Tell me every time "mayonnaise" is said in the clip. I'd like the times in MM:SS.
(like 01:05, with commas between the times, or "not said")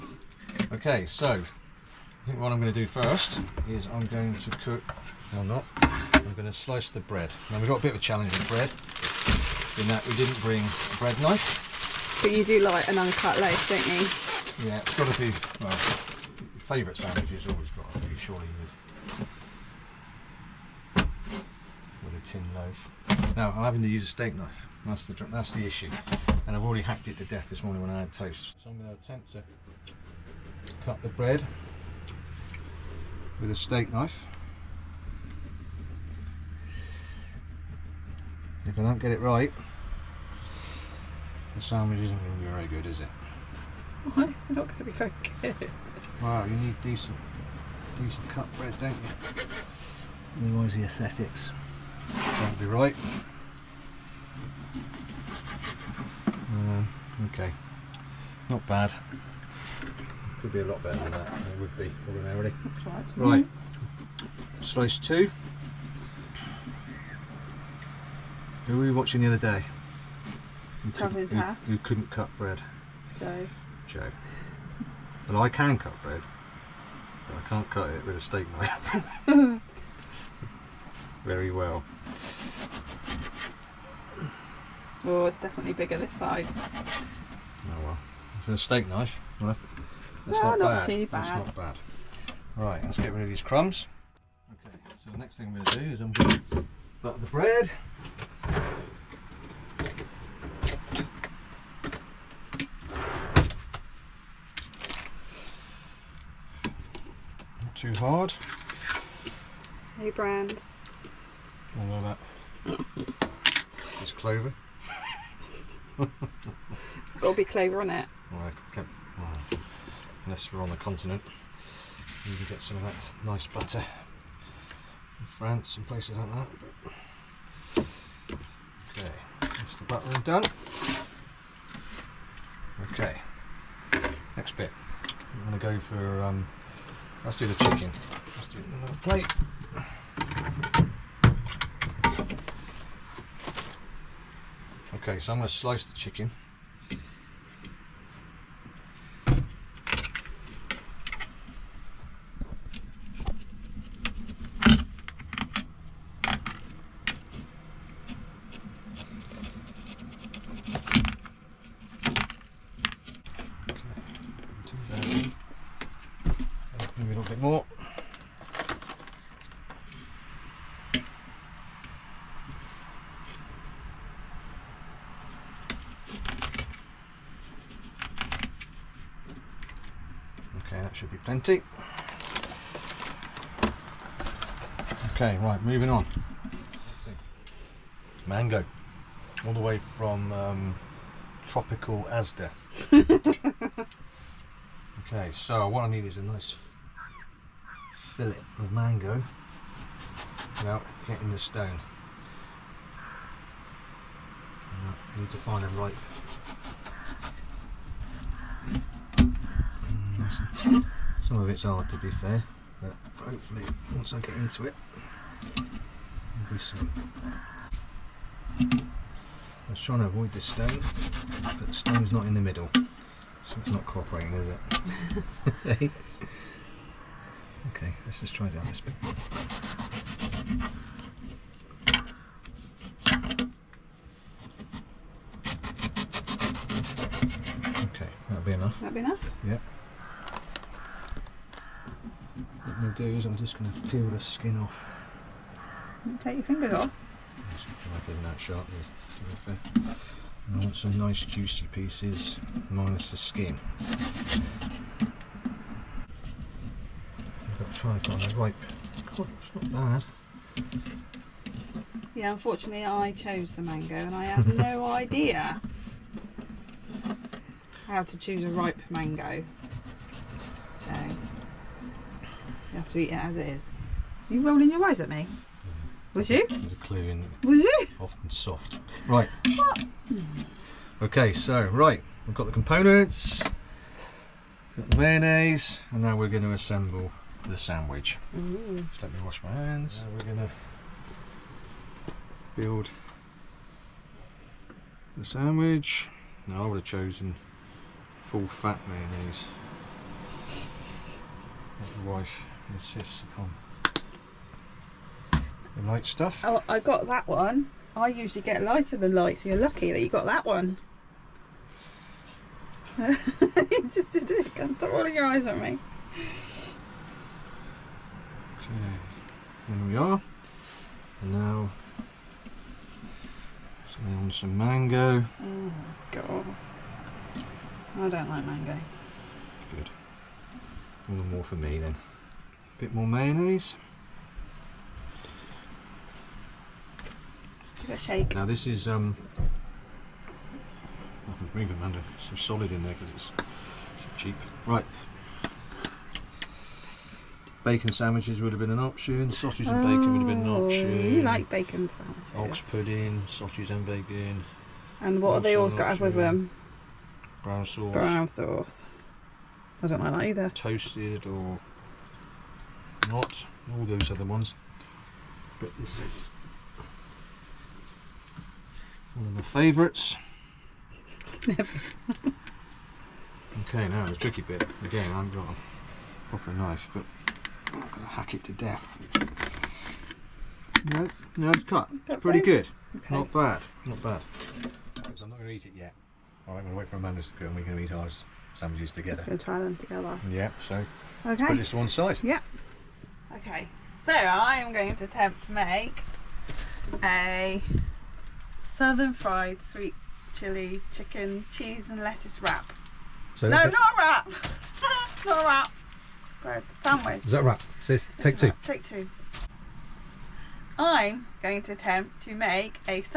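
04:44, 04:58, 05:33.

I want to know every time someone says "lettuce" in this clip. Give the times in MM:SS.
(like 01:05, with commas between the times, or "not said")
06:42.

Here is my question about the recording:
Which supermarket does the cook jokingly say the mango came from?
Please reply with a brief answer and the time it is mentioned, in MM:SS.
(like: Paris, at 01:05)
Asda, at 03:11.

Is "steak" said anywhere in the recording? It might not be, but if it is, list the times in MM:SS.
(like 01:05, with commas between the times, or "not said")
00:24, 00:33, 01:18, 01:28.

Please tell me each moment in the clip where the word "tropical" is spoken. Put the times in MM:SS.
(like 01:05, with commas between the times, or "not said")
03:11.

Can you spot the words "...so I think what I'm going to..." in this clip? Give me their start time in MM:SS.
00:01.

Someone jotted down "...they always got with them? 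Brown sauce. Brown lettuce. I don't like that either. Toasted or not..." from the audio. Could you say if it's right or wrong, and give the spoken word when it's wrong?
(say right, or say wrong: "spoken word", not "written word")
wrong: "sauce", not "lettuce".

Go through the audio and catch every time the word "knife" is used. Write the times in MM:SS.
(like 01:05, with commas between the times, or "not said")
00:11, 00:24, 00:33, 01:18, 01:28, 06:16.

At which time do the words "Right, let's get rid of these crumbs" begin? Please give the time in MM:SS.
01:32.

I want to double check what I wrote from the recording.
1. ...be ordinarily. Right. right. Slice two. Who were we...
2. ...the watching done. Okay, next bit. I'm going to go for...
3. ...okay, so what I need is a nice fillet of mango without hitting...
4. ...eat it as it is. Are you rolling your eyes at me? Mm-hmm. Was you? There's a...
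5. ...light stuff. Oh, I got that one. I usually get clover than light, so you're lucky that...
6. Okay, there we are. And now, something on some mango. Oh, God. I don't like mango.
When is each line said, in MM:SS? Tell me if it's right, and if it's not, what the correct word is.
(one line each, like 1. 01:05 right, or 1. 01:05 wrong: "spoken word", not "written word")
1. 01:01 right
2. 02:09 wrong: "buttering", not "watching"
3. 03:15 right
4. 04:32 right
5. 05:05 wrong: "lighter", not "clover"
6. 05:18 right.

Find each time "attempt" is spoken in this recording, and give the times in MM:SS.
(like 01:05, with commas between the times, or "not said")
00:29, 06:35, 06:51.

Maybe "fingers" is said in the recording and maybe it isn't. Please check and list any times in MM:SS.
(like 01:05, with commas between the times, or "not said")
04:06.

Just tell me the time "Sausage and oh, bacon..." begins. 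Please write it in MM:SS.
05:49.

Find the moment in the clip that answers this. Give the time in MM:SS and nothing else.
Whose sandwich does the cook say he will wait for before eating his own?
06:26.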